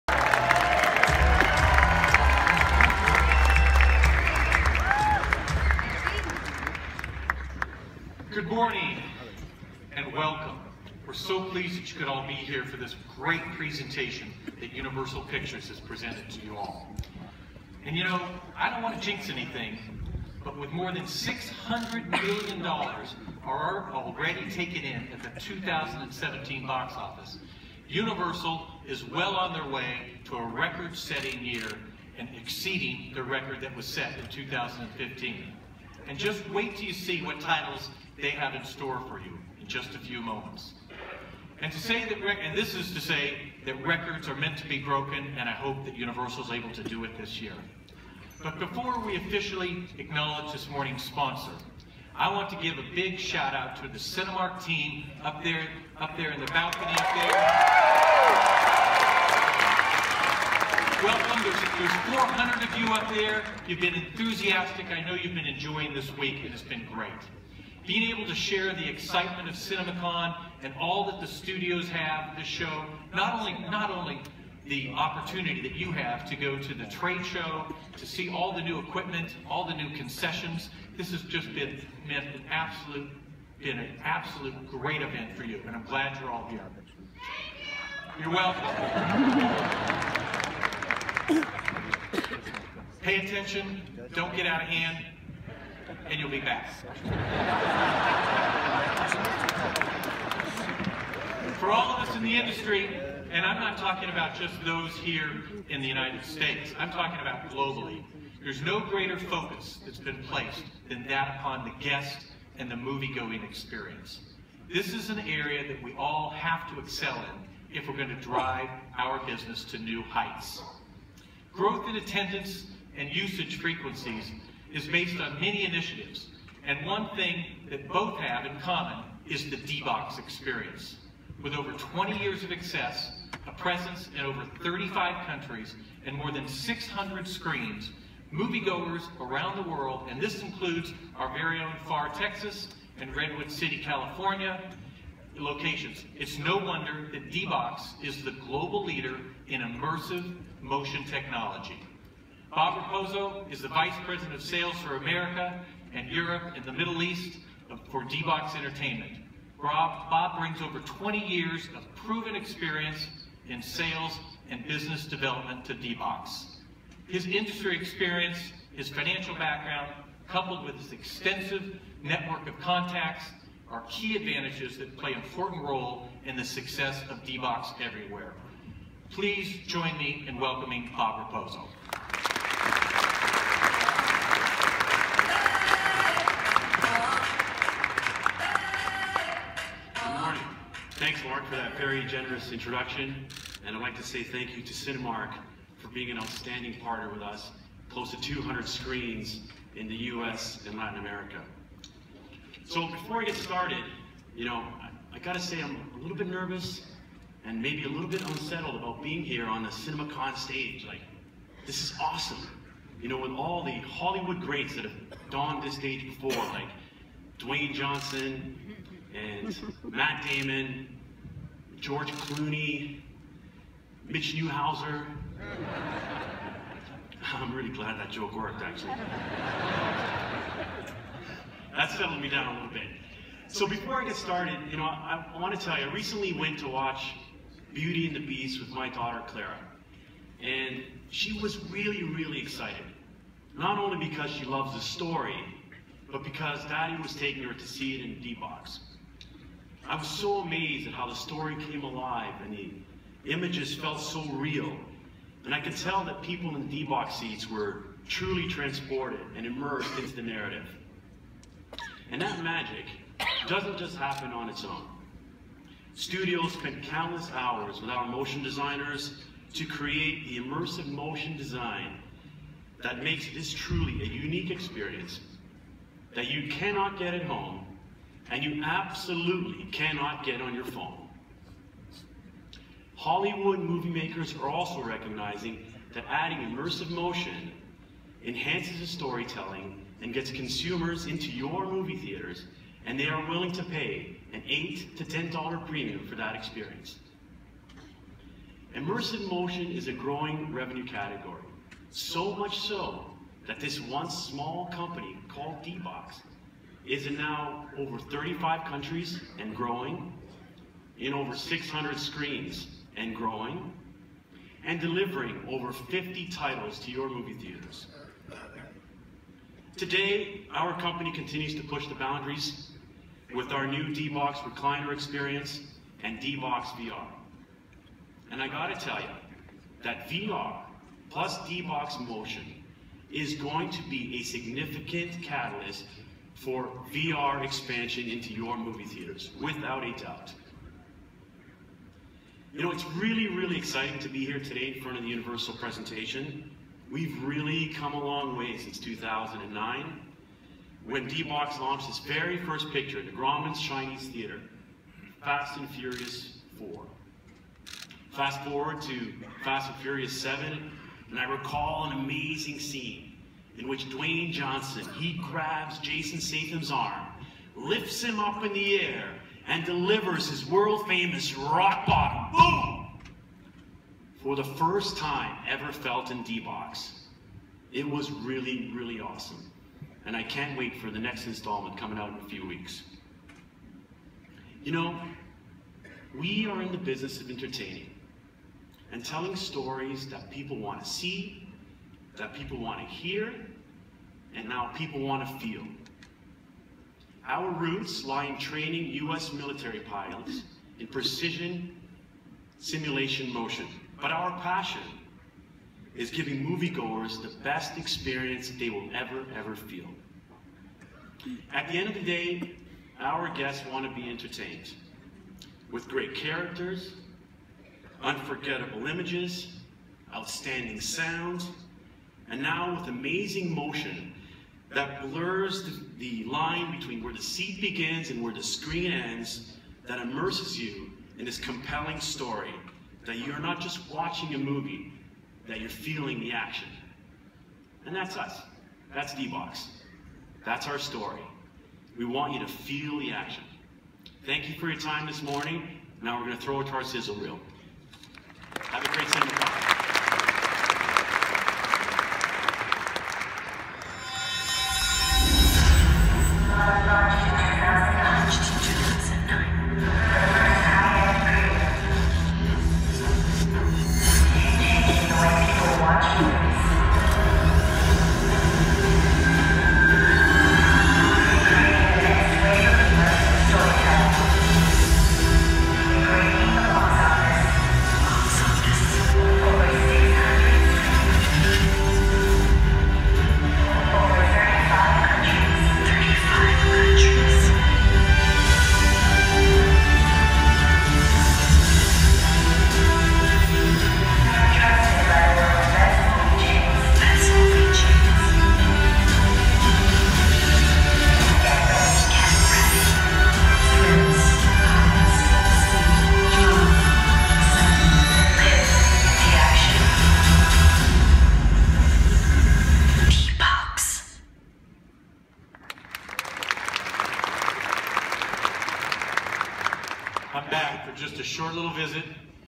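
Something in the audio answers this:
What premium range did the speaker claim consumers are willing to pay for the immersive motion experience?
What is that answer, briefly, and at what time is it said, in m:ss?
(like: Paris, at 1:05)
$8 to $10, at 4:54.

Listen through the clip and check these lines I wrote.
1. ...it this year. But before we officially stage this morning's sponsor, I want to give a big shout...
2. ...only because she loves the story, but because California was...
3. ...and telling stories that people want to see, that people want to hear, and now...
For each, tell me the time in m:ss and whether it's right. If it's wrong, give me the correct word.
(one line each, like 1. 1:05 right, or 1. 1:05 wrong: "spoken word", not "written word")
1. 0:47 wrong: "acknowledge", not "stage"
2. 4:03 wrong: "Daddy", not "California"
3. 6:28 right.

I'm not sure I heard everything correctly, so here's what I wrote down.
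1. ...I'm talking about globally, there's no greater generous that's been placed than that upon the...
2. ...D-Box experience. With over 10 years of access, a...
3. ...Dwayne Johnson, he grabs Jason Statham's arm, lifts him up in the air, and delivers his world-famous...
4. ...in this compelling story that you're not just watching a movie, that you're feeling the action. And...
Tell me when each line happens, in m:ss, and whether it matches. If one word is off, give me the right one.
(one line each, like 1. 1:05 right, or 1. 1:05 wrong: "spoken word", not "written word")
1. 1:46 wrong: "focus", not "generous"
2. 2:09 wrong: "20", not "10"
3. 6:03 right
4. 7:11 right.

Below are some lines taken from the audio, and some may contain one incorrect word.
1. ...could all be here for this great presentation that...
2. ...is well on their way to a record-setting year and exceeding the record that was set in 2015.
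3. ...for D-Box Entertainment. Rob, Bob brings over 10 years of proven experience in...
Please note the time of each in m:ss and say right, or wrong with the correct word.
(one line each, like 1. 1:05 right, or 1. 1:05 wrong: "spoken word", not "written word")
1. 0:11 right
2. 0:28 right
3. 2:37 wrong: "20", not "10".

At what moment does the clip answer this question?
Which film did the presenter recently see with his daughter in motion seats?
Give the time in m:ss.
3:57.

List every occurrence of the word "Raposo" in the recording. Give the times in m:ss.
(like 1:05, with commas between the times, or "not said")
2:32, 3:01.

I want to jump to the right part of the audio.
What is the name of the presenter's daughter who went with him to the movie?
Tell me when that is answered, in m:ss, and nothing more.
3:59.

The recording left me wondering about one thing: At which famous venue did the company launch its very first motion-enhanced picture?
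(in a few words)
Grauman's Chinese Theater.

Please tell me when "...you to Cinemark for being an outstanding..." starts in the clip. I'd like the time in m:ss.
3:14.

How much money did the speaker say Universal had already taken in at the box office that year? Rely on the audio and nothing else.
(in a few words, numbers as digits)
$600 million.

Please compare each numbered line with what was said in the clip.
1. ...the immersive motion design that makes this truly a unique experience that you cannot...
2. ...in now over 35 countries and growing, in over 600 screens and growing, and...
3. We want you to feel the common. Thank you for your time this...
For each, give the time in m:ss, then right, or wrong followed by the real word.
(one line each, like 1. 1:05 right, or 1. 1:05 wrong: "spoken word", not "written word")
1. 4:30 right
2. 5:07 right
3. 7:21 wrong: "action", not "common".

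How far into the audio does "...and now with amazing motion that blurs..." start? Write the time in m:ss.
7:02.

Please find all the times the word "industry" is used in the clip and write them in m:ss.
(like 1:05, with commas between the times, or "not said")
1:42, 2:47.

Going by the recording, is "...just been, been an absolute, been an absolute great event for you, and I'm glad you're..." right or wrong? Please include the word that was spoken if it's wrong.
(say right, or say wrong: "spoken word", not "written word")
right.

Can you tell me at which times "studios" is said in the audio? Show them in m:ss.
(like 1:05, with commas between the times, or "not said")
1:11, 4:25.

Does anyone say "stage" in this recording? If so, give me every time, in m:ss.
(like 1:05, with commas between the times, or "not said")
3:30, 3:35.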